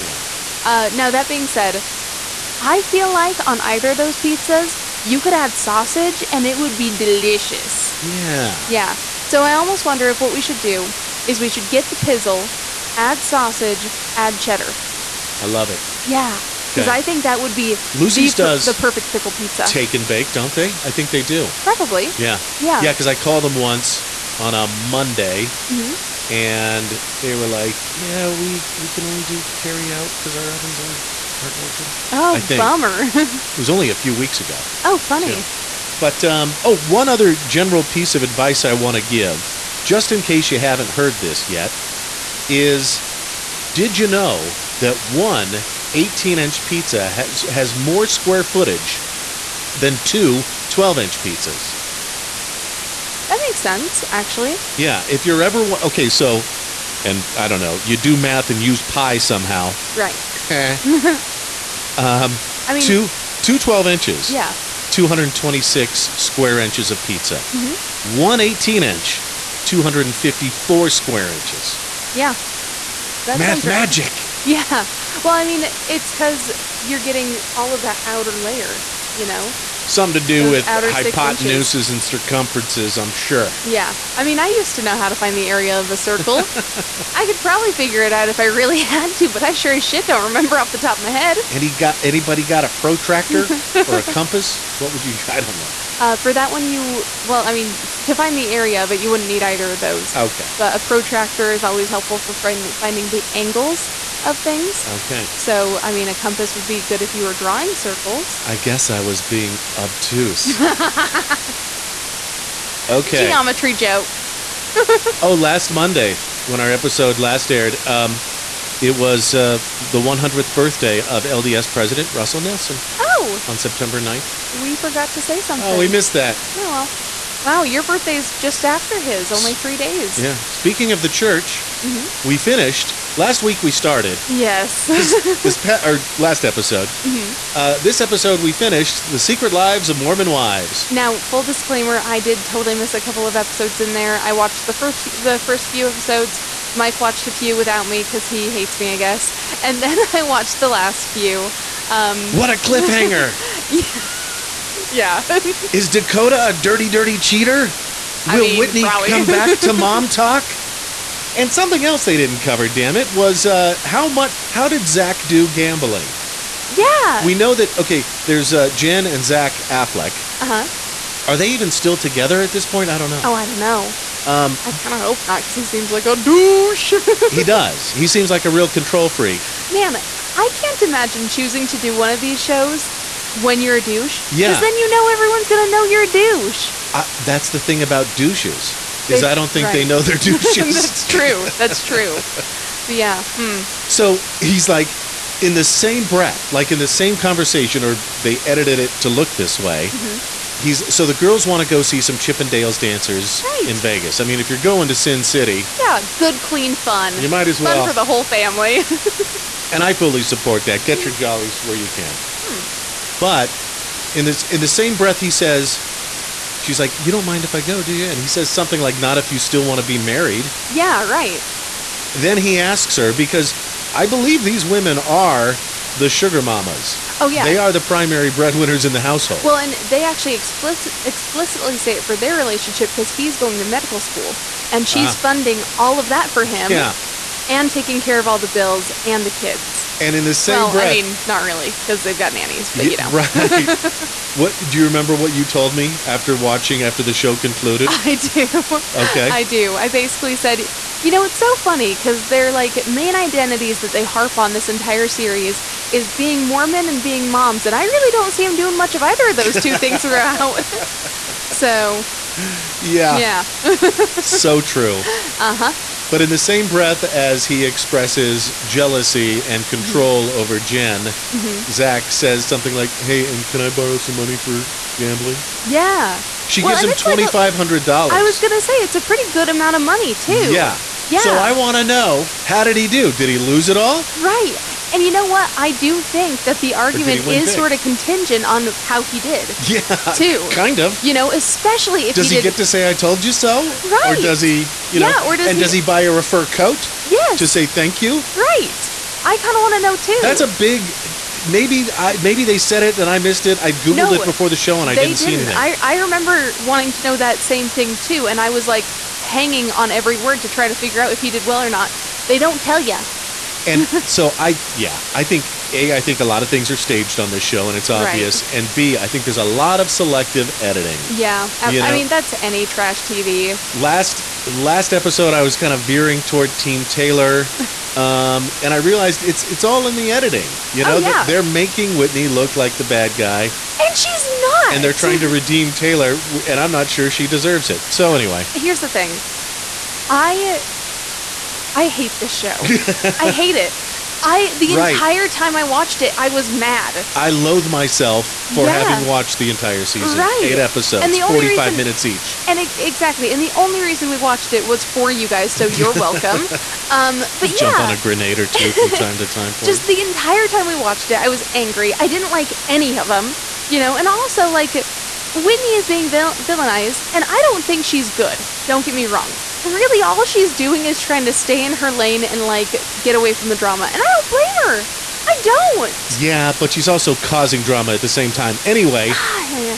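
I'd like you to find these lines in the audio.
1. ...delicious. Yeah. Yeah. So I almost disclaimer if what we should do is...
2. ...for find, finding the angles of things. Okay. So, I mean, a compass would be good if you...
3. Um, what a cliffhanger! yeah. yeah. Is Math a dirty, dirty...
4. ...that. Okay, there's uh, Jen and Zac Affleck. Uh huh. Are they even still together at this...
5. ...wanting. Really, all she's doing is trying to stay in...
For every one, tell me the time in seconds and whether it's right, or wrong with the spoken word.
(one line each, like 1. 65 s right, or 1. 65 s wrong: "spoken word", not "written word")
1. 6 s wrong: "wonder", not "disclaimer"
2. 102 s right
3. 151 s wrong: "Dakota", not "Math"
4. 167 s right
5. 369 s wrong: "wrong", not "wanting".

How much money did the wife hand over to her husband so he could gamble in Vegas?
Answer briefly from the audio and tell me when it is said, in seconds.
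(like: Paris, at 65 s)
$2,500, at 276 s.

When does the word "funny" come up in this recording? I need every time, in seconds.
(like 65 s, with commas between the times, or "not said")
34 s, 251 s.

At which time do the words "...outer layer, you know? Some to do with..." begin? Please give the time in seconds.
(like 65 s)
78 s.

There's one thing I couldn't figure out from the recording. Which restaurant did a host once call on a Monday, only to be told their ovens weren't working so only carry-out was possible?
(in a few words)
Lucy's.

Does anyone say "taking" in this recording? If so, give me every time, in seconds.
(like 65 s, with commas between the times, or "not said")
237 s.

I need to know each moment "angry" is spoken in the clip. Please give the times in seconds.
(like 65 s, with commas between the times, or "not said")
361 s.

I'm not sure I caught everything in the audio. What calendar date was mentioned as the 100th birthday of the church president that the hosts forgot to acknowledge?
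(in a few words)
September 9th.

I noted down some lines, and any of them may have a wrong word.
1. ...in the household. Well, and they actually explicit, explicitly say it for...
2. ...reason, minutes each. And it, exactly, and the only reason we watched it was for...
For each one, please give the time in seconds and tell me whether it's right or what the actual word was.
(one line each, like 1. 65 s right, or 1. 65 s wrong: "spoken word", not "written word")
1. 228 s right
2. 351 s right.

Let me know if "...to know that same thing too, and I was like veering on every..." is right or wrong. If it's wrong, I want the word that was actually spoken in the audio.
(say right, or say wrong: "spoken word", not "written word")
wrong: "hanging", not "veering".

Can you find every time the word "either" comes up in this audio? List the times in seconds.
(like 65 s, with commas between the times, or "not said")
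3 s, 99 s, 259 s.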